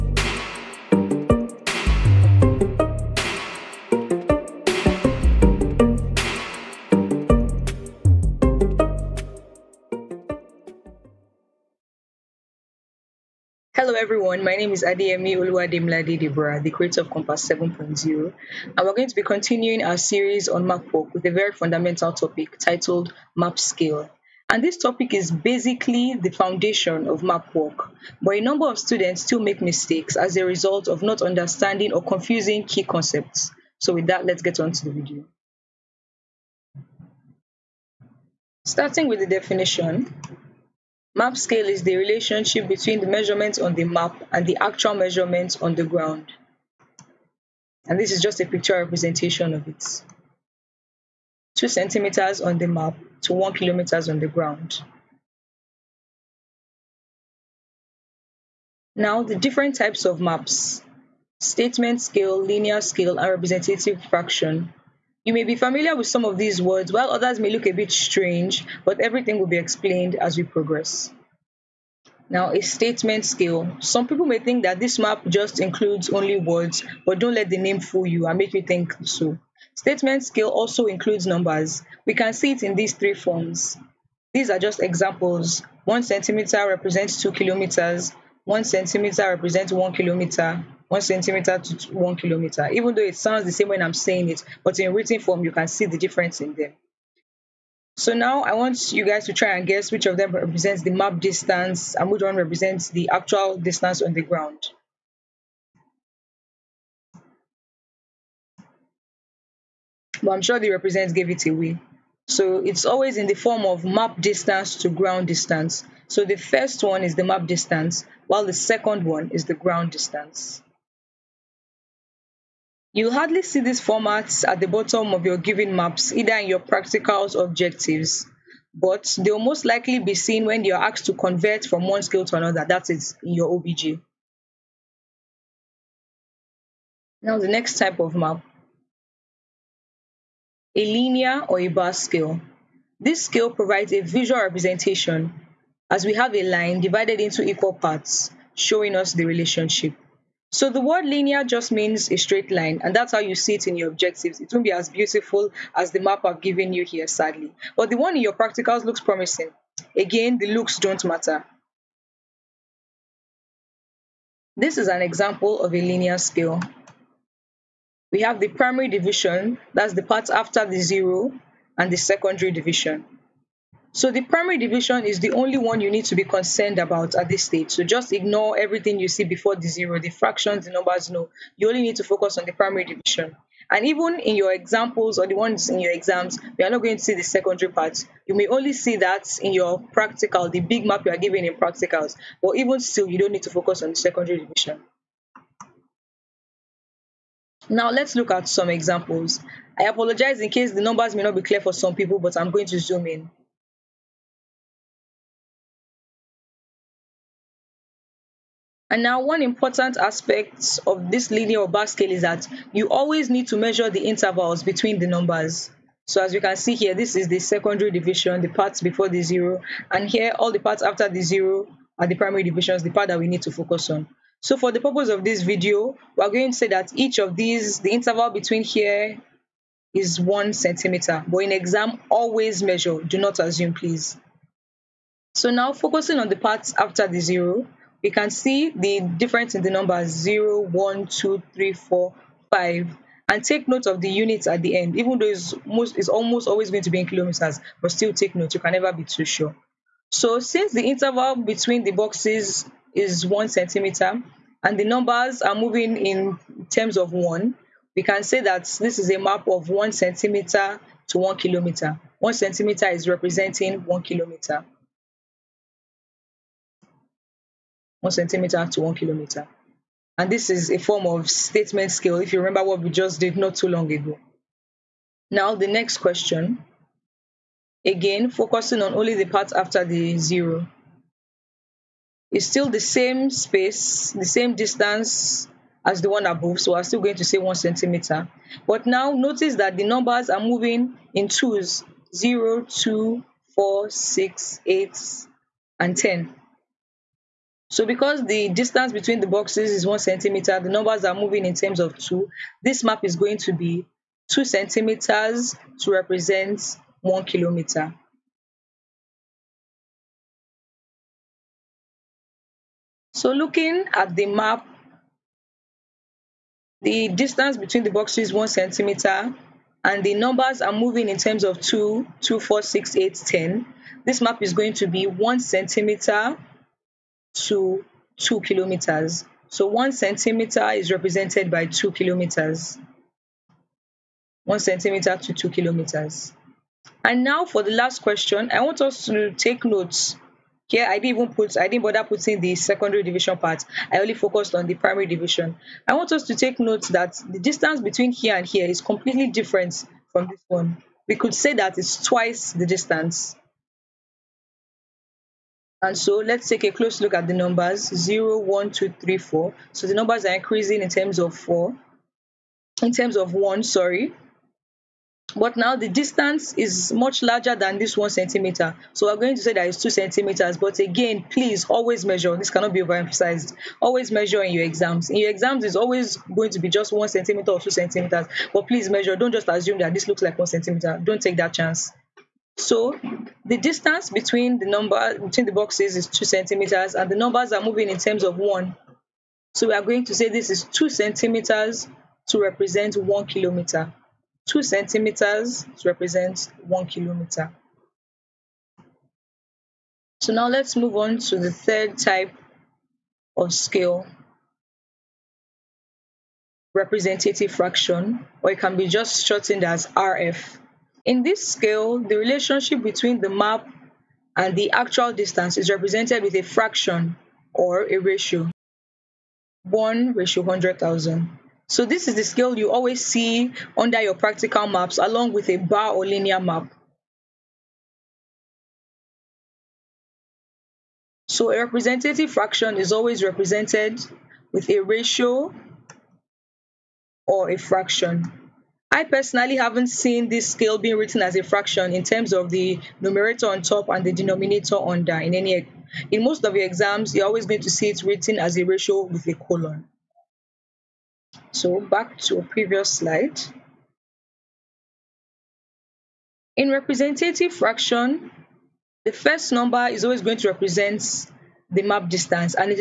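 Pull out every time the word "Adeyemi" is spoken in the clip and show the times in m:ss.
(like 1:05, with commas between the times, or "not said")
0:14.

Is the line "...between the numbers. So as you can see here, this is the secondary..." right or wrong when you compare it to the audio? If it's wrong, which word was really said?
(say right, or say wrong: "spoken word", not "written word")
right.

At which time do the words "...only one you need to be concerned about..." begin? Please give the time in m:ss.
2:55.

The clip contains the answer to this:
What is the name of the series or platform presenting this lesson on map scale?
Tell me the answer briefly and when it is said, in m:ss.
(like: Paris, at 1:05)
Compass 7.0, at 0:17.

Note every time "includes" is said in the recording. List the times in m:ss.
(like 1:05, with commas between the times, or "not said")
1:15, 1:20.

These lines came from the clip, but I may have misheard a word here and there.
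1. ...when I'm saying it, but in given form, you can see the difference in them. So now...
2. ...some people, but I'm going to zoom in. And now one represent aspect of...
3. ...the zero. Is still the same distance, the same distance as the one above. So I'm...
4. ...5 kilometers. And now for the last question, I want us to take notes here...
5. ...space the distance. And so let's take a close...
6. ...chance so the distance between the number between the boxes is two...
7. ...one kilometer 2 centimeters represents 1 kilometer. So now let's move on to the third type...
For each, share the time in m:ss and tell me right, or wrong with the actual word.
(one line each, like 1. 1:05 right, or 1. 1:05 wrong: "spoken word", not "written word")
1. 1:33 wrong: "written", not "given"
2. 3:21 wrong: "important", not "represent"
3. 4:39 wrong: "space", not "distance"
4. 5:35 wrong: "2", not "5"
5. 5:52 wrong: "twice", not "space"
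6. 6:21 right
7. 6:32 right.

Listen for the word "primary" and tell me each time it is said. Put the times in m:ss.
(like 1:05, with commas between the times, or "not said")
2:48, 2:54, 3:02, 3:42, 5:44.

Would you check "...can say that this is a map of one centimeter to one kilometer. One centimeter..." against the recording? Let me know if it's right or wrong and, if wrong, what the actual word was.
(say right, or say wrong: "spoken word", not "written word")
right.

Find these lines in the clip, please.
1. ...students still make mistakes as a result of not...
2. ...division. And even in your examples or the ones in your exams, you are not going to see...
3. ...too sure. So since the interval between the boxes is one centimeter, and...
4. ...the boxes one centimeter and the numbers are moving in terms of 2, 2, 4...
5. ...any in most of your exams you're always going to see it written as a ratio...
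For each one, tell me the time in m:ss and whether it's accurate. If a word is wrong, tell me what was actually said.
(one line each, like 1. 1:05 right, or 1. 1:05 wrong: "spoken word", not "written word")
1. 0:28 right
2. 3:02 right
3. 4:09 right
4. 5:17 right
5. 7:25 right.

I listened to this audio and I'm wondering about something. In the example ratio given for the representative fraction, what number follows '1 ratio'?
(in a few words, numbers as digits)
100,000.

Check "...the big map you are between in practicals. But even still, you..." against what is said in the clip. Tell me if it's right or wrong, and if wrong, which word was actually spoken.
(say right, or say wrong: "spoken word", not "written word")
wrong: "given", not "between".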